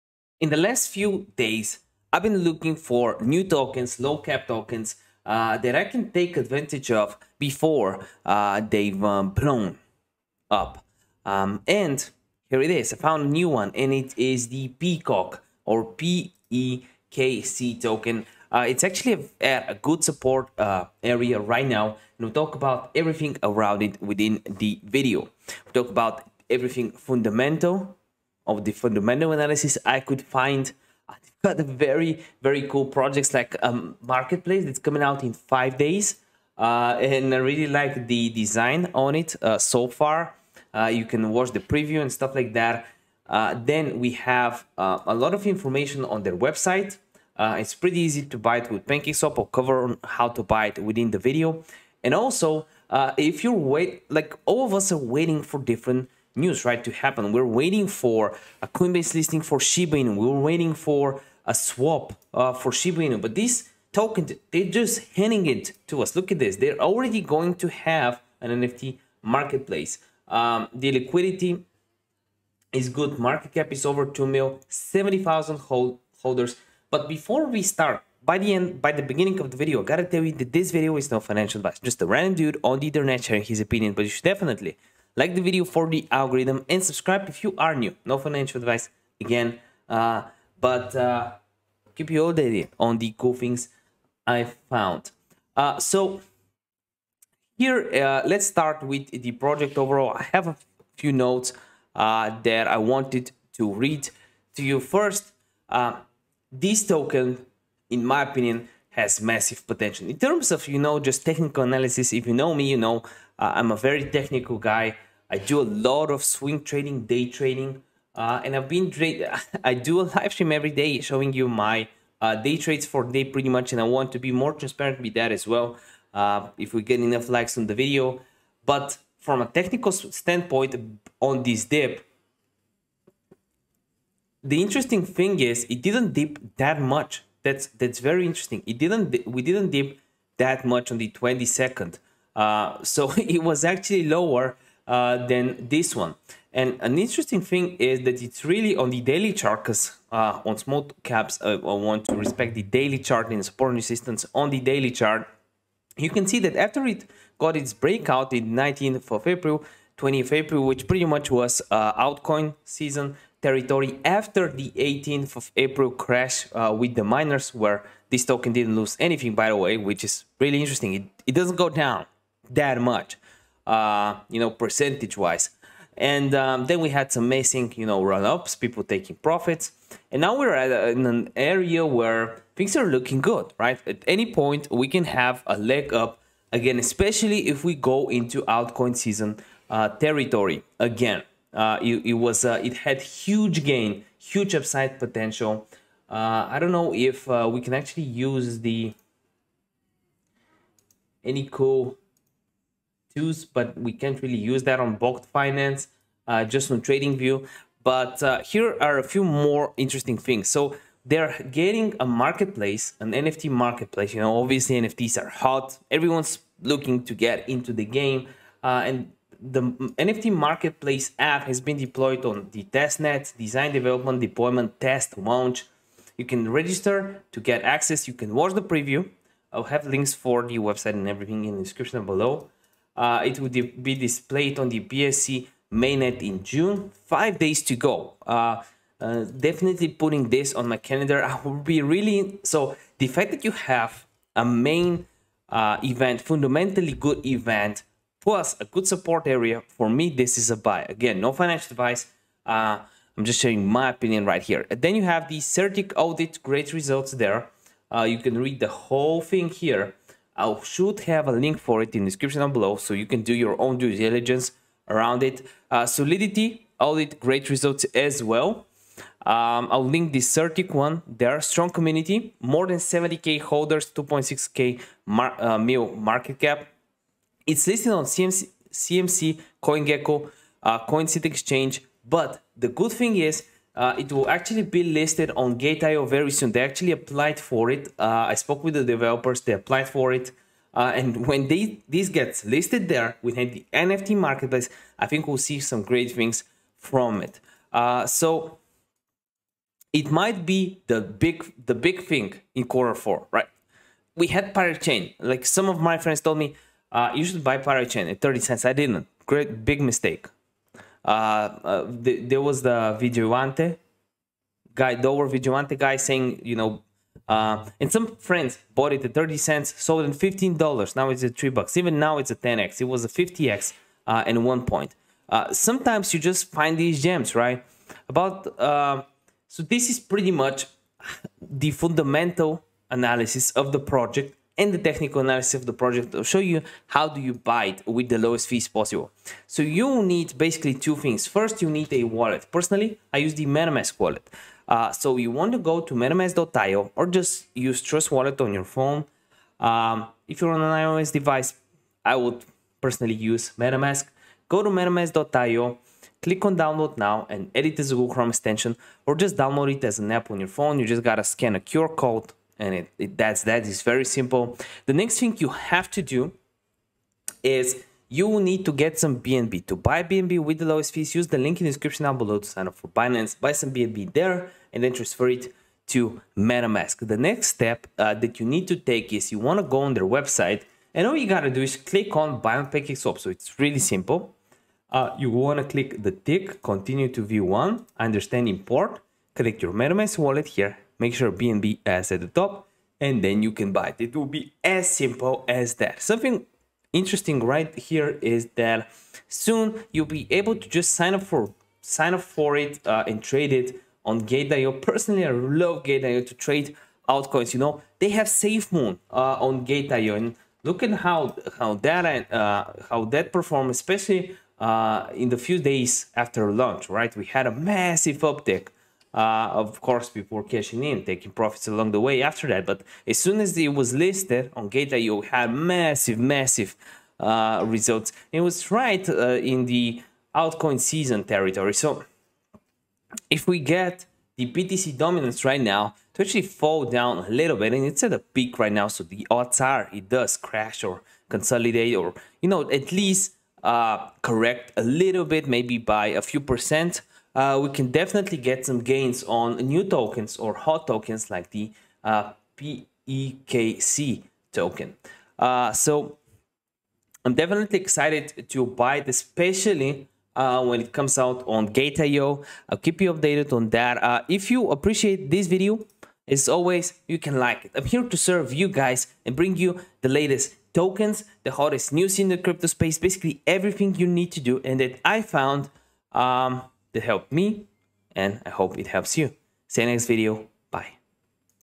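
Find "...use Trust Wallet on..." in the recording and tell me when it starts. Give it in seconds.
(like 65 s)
347 s.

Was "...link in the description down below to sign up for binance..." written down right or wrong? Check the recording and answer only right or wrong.
right.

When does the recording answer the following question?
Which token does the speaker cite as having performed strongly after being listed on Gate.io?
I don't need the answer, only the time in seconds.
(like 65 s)
408 s.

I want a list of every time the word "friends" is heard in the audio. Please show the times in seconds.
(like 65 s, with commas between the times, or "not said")
305 s, 318 s.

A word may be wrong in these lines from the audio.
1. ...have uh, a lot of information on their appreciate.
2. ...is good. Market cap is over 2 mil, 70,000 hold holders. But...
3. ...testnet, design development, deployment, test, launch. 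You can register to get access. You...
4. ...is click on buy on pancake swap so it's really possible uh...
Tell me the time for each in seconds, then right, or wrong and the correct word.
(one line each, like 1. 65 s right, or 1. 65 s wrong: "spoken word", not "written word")
1. 44 s wrong: "website", not "appreciate"
2. 72 s right
3. 222 s right
4. 381 s wrong: "simple", not "possible".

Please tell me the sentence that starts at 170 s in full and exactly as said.
It, it doesn't go down that much, uh, you know, percentage-wise.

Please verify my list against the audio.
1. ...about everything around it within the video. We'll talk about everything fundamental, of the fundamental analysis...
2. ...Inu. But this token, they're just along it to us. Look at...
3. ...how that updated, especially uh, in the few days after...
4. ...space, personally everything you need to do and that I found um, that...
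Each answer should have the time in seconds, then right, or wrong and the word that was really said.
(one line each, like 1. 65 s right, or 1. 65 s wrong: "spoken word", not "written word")
1. 22 s right
2. 63 s wrong: "handing", not "along"
3. 412 s wrong: "performed", not "updated"
4. 472 s wrong: "basically", not "personally".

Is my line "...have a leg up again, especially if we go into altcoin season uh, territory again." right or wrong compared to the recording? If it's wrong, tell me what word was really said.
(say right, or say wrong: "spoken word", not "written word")
right.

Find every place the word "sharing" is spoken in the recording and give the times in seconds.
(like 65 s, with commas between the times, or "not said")
83 s, 253 s.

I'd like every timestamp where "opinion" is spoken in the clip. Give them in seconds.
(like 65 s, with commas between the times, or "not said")
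83 s, 108 s, 253 s.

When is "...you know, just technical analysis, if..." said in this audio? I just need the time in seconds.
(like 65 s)
110 s.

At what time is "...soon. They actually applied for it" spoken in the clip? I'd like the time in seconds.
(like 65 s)
286 s.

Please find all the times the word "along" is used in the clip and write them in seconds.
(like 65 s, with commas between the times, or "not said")
421 s.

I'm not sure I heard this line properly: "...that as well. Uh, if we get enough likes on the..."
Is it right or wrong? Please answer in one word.
right.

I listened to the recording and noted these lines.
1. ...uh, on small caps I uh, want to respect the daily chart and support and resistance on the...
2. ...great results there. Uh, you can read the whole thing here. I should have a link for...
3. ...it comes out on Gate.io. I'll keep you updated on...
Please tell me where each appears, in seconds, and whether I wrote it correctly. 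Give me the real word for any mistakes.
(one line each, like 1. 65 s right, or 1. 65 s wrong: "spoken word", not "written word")
1. 150 s right
2. 256 s right
3. 460 s right.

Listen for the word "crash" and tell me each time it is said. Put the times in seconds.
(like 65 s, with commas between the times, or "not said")
165 s, 440 s.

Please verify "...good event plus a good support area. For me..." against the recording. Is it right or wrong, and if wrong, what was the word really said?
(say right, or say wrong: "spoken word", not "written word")
right.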